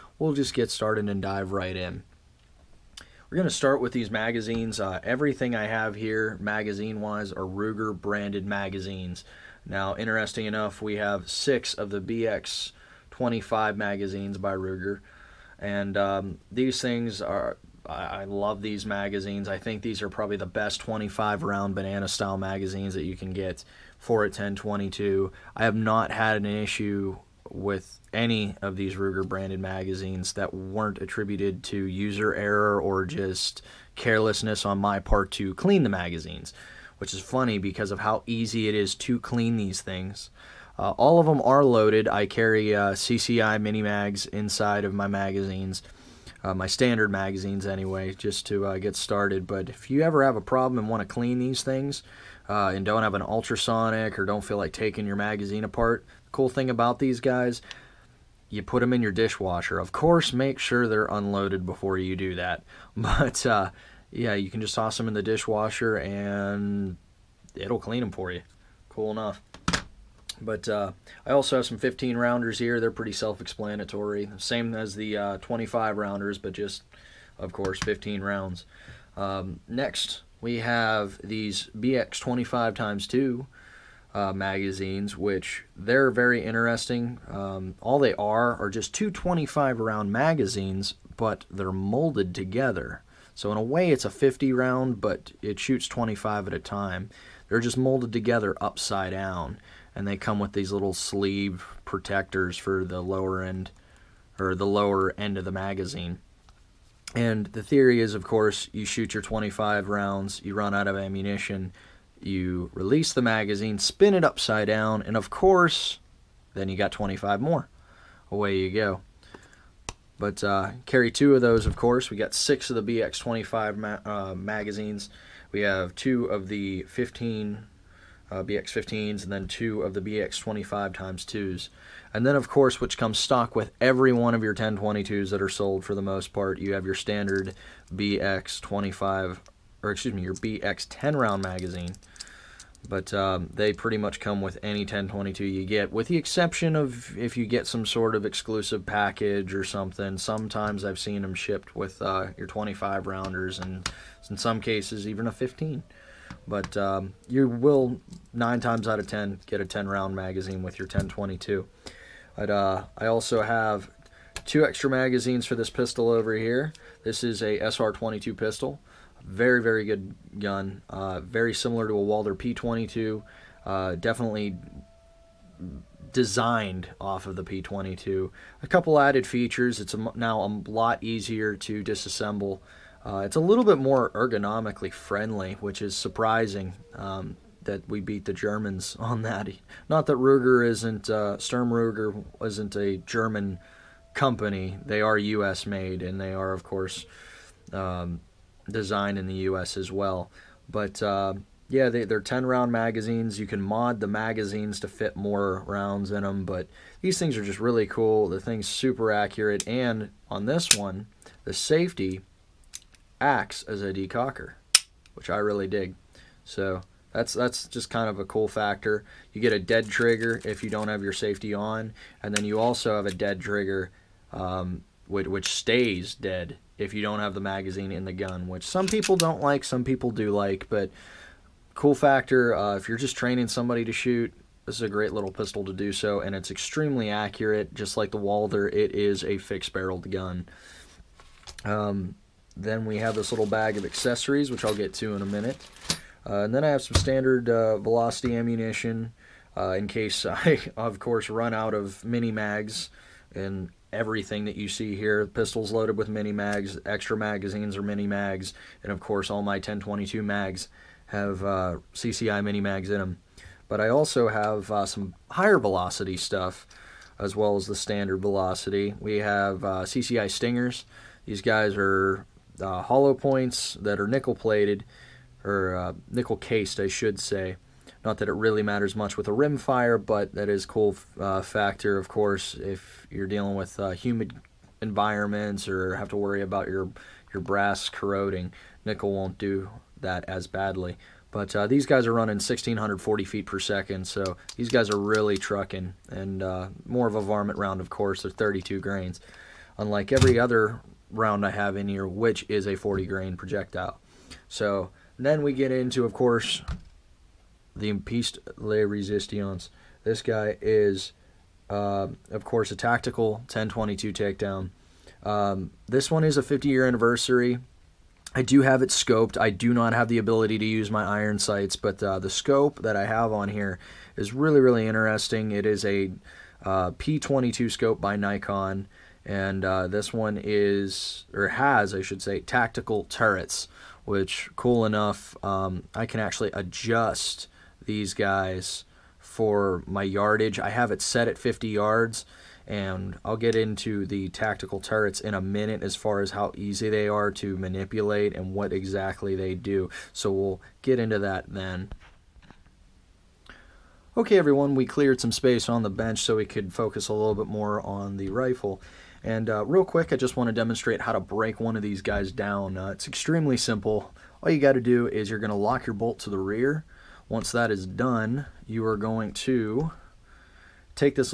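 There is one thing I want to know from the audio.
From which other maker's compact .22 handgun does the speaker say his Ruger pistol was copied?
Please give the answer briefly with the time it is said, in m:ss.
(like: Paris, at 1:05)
Walther P22, at 2:52.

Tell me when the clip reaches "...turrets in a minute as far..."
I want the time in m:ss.
5:44.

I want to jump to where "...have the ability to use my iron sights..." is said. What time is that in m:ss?
5:19.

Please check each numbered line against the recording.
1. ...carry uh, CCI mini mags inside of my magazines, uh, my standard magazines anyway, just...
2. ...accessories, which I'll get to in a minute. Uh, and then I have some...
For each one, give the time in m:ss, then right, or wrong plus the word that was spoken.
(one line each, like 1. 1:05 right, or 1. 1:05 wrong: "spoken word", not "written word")
1. 0:42 right
2. 4:03 right.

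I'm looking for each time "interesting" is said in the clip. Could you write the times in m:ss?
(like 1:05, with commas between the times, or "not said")
0:09, 1:26, 5:24.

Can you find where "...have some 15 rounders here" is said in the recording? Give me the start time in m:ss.
1:11.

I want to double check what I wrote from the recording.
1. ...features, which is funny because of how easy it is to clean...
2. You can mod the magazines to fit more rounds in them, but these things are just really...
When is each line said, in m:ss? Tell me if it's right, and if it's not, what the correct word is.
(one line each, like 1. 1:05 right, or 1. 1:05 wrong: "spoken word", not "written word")
1. 0:35 wrong: "magazines", not "features"
2. 3:23 right.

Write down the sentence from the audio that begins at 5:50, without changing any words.
So we'll get into that then.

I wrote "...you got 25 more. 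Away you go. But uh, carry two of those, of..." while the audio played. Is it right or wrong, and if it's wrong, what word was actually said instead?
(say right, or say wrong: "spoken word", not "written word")
right.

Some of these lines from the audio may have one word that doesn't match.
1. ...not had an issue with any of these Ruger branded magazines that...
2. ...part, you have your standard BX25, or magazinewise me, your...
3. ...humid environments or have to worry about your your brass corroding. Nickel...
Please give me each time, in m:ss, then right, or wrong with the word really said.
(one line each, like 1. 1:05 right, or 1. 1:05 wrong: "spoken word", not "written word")
1. 0:25 right
2. 2:16 wrong: "excuse", not "magazinewise"
3. 4:43 right.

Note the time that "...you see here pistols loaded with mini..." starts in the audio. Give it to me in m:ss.
4:14.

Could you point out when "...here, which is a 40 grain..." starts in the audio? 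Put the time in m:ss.
5:01.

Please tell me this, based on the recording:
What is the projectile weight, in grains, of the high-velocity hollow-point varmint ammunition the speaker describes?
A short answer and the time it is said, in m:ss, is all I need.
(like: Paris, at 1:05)
32 grains, at 4:58.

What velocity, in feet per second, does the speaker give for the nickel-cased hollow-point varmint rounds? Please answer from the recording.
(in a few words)
1,640.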